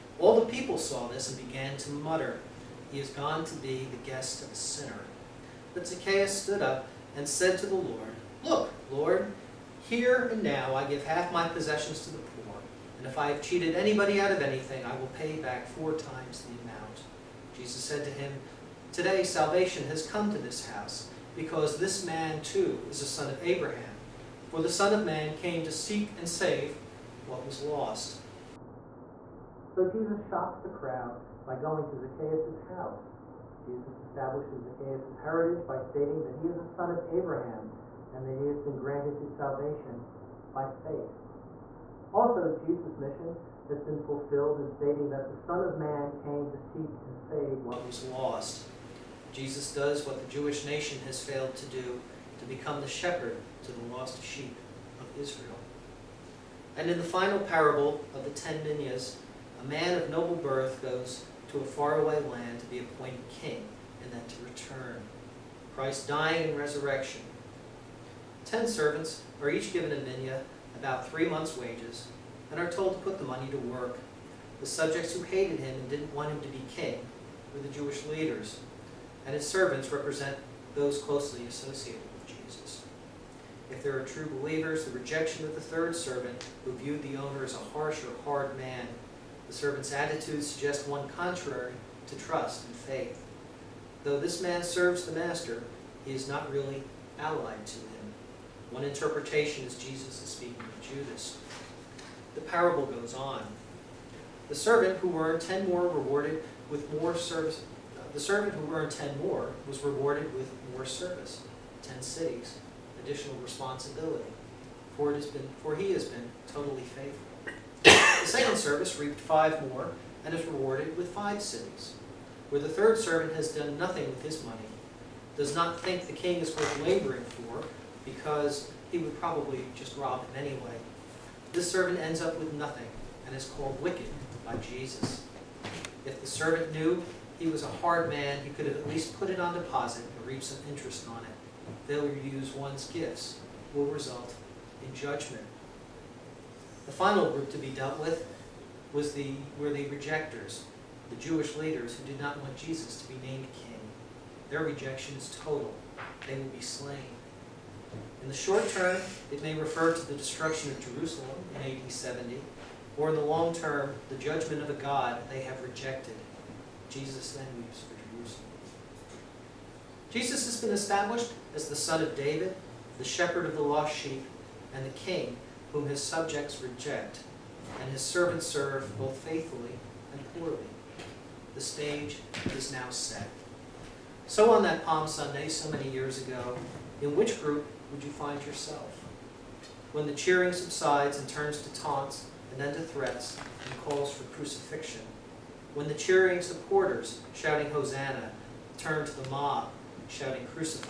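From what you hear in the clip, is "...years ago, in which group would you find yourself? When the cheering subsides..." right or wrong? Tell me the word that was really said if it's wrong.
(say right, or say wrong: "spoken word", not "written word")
right.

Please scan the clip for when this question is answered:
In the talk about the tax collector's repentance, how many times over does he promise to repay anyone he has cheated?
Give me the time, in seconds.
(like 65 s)
15 s.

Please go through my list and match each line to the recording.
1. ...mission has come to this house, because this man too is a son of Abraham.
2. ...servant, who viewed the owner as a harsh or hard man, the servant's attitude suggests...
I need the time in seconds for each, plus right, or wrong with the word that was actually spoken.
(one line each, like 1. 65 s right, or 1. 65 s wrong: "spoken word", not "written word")
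1. 19 s wrong: "salvation", not "mission"
2. 85 s right.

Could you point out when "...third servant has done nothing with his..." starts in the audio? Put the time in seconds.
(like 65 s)
122 s.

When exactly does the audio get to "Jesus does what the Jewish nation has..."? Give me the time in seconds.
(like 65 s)
49 s.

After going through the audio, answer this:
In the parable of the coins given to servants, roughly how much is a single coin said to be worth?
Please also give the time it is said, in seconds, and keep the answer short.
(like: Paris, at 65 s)
3 months' wages, at 71 s.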